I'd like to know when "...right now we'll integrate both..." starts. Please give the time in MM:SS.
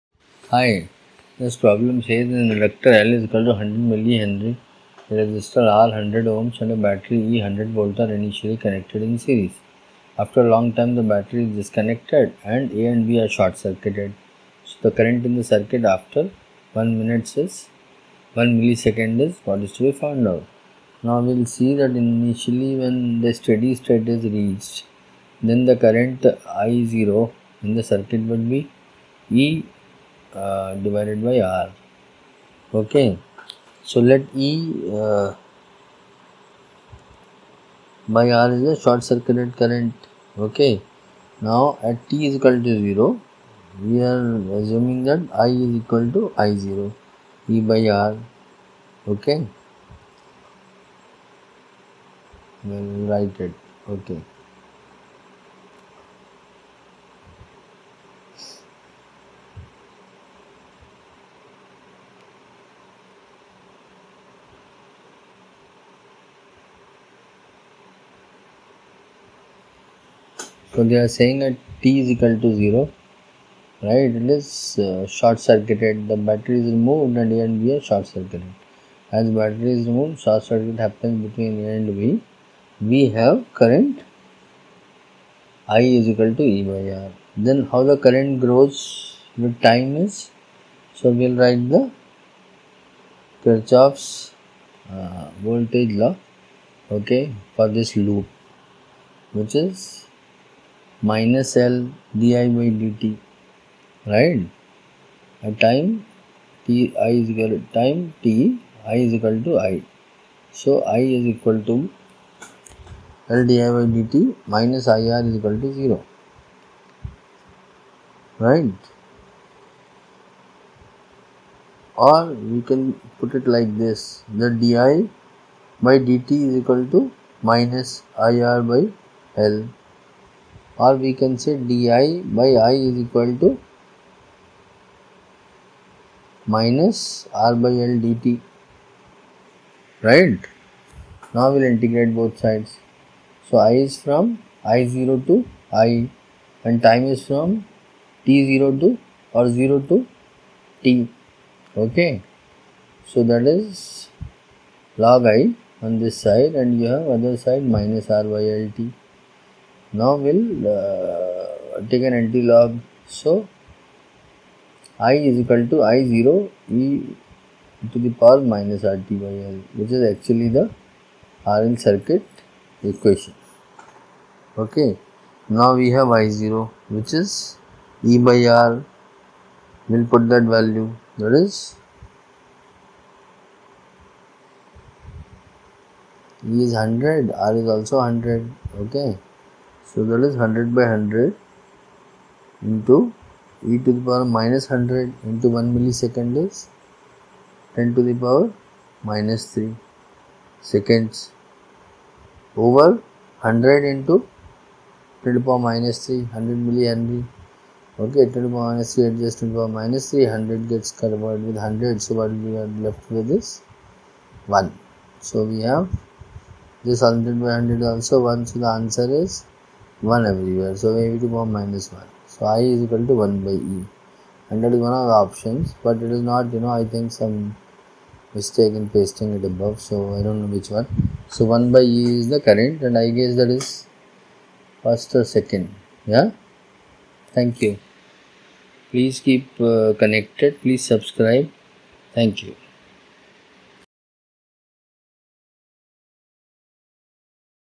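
02:20.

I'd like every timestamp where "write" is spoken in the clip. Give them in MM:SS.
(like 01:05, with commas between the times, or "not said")
00:53, 01:31.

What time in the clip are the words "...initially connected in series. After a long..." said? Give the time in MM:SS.
00:08.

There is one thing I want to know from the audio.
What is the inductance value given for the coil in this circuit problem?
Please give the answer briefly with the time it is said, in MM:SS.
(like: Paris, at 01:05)
100 mH, at 00:03.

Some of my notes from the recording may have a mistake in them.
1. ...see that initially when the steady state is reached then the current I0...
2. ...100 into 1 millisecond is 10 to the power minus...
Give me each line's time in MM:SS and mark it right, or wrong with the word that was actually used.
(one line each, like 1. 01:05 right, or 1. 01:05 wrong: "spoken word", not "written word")
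1. 00:21 right
2. 03:14 right.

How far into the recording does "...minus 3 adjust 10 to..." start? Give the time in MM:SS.
03:28.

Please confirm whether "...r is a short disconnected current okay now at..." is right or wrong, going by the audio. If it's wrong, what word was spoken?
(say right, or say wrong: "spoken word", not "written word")
wrong: "circuited", not "disconnected".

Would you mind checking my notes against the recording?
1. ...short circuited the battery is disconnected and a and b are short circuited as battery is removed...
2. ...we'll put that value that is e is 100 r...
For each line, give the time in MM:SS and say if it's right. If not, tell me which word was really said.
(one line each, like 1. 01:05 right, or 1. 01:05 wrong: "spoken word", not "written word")
1. 01:15 wrong: "removed", not "disconnected"
2. 02:59 right.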